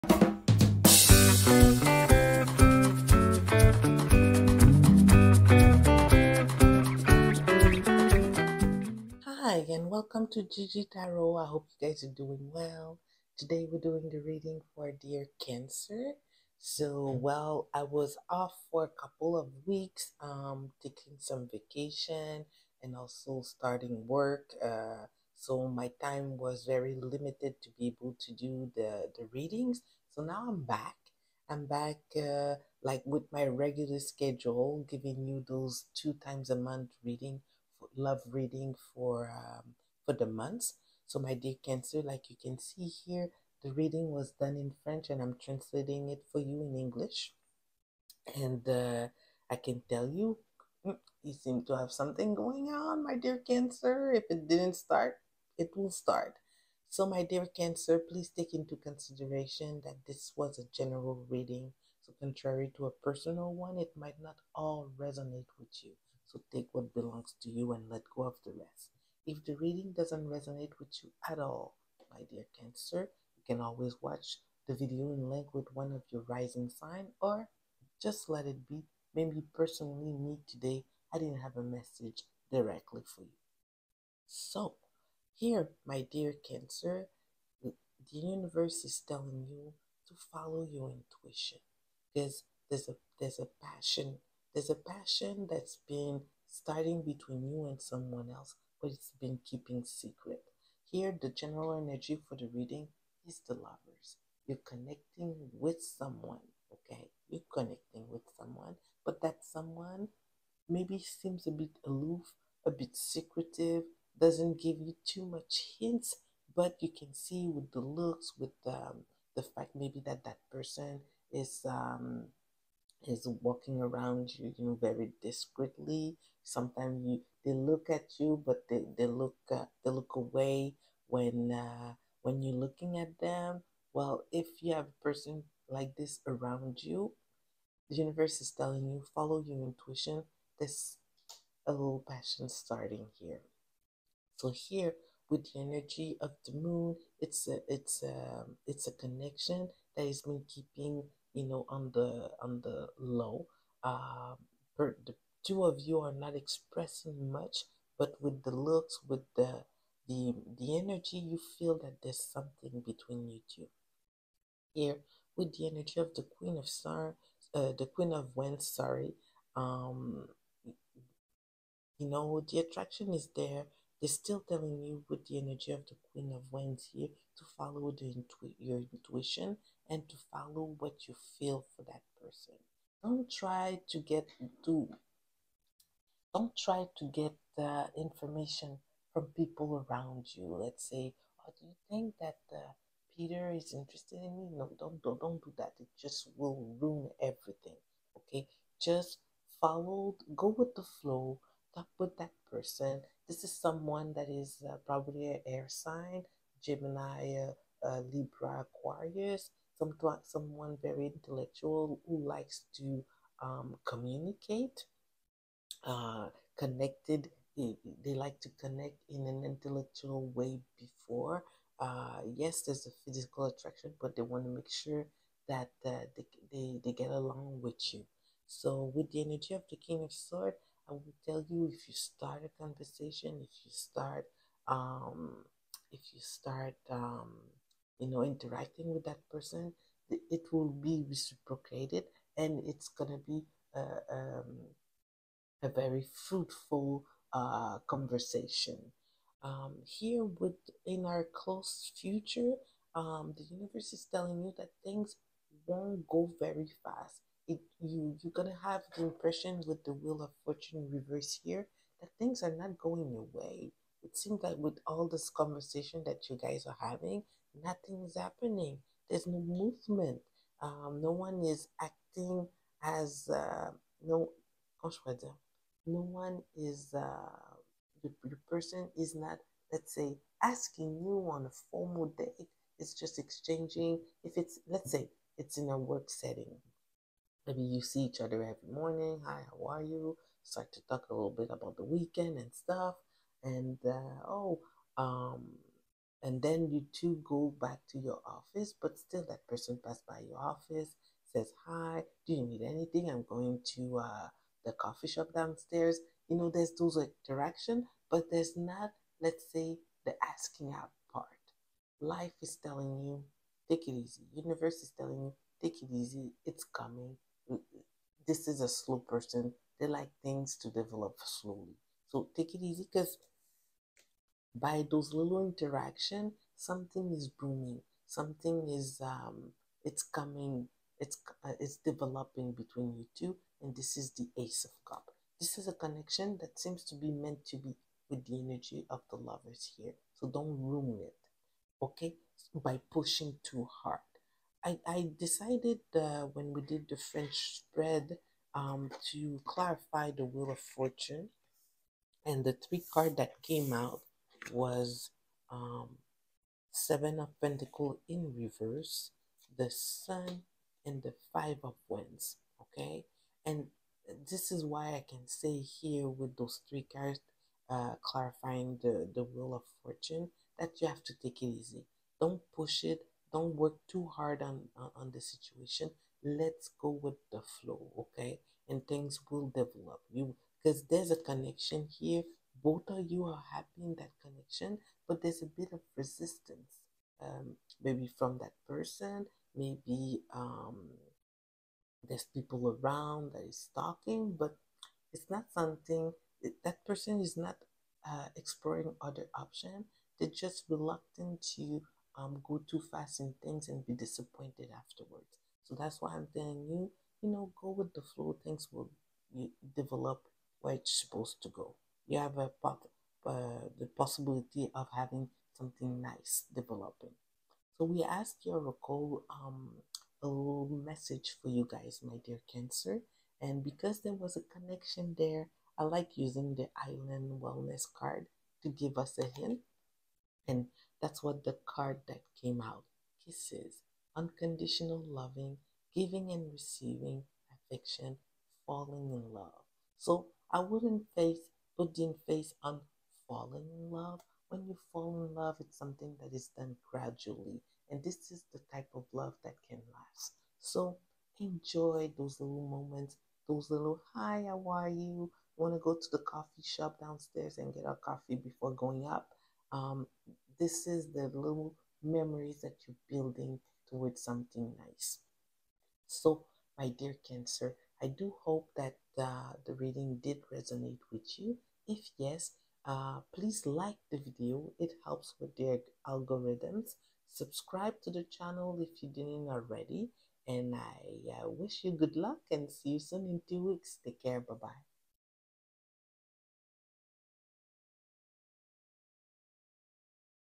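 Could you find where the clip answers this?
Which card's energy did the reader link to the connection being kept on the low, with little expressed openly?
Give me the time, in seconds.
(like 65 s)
145 s.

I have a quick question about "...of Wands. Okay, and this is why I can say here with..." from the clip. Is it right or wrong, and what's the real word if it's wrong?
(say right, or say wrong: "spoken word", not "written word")
right.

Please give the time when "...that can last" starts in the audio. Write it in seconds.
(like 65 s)
449 s.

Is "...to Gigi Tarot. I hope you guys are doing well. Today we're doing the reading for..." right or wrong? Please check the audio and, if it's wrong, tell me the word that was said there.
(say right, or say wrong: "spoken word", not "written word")
right.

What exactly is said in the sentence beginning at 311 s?
Life is telling you, take it easy.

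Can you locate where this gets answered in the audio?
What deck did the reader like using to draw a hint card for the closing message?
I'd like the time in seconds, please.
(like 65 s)
426 s.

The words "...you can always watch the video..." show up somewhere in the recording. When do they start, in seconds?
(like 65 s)
73 s.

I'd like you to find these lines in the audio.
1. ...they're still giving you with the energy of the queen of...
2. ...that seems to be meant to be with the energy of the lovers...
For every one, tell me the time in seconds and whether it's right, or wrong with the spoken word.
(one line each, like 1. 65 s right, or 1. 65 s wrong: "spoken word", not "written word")
1. 174 s wrong: "telling", not "giving"
2. 336 s right.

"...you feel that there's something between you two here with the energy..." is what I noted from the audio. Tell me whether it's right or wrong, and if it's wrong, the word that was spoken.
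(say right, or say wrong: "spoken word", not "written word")
right.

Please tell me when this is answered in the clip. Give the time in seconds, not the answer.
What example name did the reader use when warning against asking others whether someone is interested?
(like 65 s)
193 s.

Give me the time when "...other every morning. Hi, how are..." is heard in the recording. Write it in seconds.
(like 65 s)
288 s.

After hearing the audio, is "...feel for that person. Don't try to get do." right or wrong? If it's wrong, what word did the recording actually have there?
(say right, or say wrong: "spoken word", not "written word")
right.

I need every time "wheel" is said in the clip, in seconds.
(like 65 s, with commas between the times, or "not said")
259 s, 350 s, 369 s.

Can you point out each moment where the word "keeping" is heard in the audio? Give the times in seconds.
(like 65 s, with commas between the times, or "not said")
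99 s, 150 s.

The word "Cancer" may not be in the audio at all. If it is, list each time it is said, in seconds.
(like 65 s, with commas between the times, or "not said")
15 s, 41 s, 53 s, 57 s, 72 s, 86 s, 422 s, 467 s.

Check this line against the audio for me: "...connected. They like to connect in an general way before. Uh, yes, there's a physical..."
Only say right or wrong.
wrong.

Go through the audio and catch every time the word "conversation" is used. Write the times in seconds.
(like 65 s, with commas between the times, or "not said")
232 s, 247 s, 265 s.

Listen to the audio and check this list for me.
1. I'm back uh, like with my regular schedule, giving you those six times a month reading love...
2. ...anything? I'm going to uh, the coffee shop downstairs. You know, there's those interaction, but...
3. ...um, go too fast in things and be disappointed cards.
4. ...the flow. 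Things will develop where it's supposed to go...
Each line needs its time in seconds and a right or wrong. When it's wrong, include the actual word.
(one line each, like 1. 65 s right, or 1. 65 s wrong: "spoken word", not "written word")
1. 31 s wrong: "two", not "six"
2. 302 s right
3. 402 s wrong: "afterwards", not "cards"
4. 407 s right.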